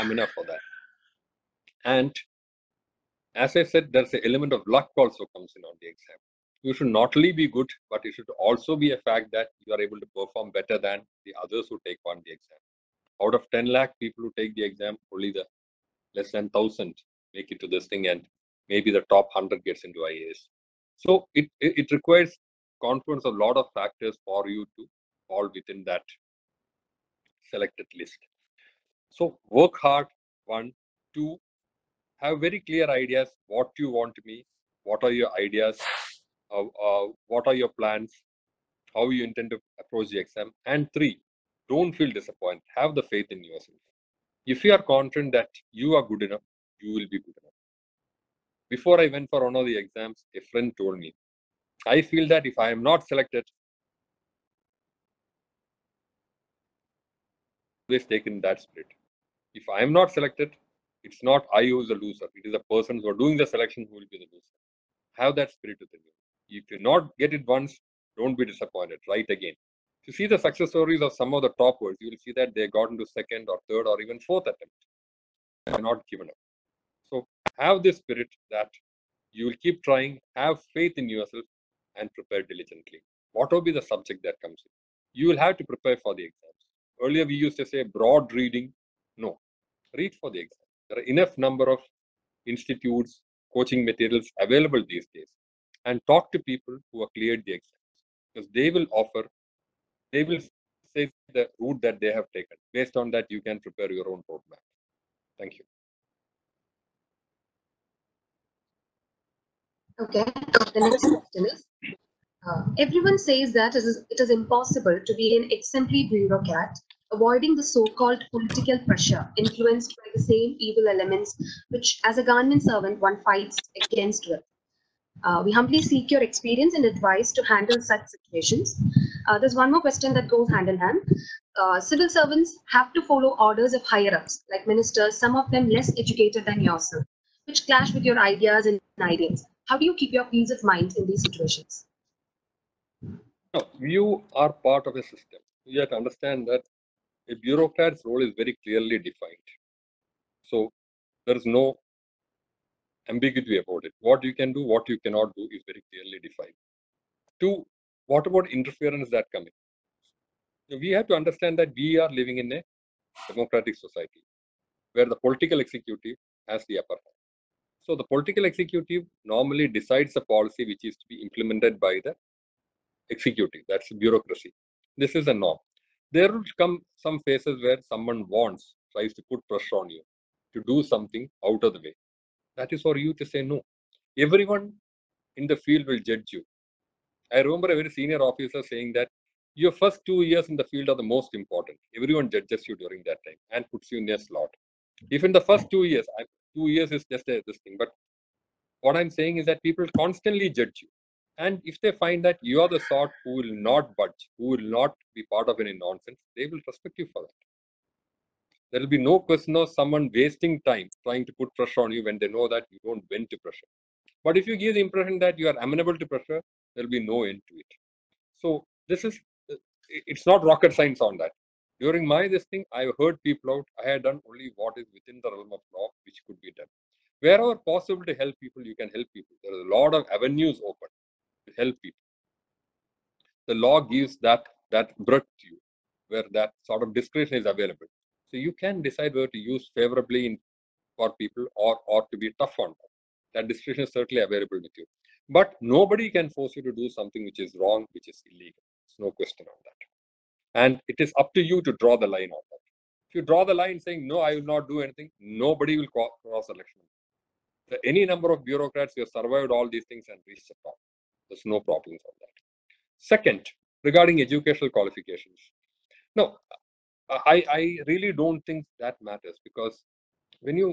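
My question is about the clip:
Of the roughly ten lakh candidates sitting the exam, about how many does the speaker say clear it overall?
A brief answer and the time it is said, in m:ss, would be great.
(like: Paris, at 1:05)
less than 1,000, at 0:16.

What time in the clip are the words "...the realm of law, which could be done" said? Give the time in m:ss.
3:45.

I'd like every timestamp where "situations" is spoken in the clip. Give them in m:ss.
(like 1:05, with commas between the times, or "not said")
2:08, 2:21.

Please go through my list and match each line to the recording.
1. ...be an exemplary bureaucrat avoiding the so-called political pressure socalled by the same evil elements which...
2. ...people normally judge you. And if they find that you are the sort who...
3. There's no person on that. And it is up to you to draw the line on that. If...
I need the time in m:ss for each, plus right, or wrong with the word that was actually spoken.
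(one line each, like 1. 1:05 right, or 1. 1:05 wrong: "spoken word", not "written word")
1. 1:55 wrong: "influenced", not "socalled"
2. 3:19 wrong: "constantly", not "normally"
3. 4:08 wrong: "question", not "person".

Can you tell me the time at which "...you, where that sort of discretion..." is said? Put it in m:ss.
3:55.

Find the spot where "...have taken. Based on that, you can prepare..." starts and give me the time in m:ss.
1:42.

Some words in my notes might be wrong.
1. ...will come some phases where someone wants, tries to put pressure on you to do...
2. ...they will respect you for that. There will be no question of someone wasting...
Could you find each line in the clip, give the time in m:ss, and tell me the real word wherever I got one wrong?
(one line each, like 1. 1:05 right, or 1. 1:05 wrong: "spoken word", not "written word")
1. 2:56 right
2. 3:26 right.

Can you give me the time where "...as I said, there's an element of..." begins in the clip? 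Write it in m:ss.
0:03.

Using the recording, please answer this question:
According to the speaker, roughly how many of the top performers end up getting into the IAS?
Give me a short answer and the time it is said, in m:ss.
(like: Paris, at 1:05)
100, at 0:19.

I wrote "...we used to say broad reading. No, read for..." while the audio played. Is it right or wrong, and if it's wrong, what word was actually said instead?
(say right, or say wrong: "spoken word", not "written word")
right.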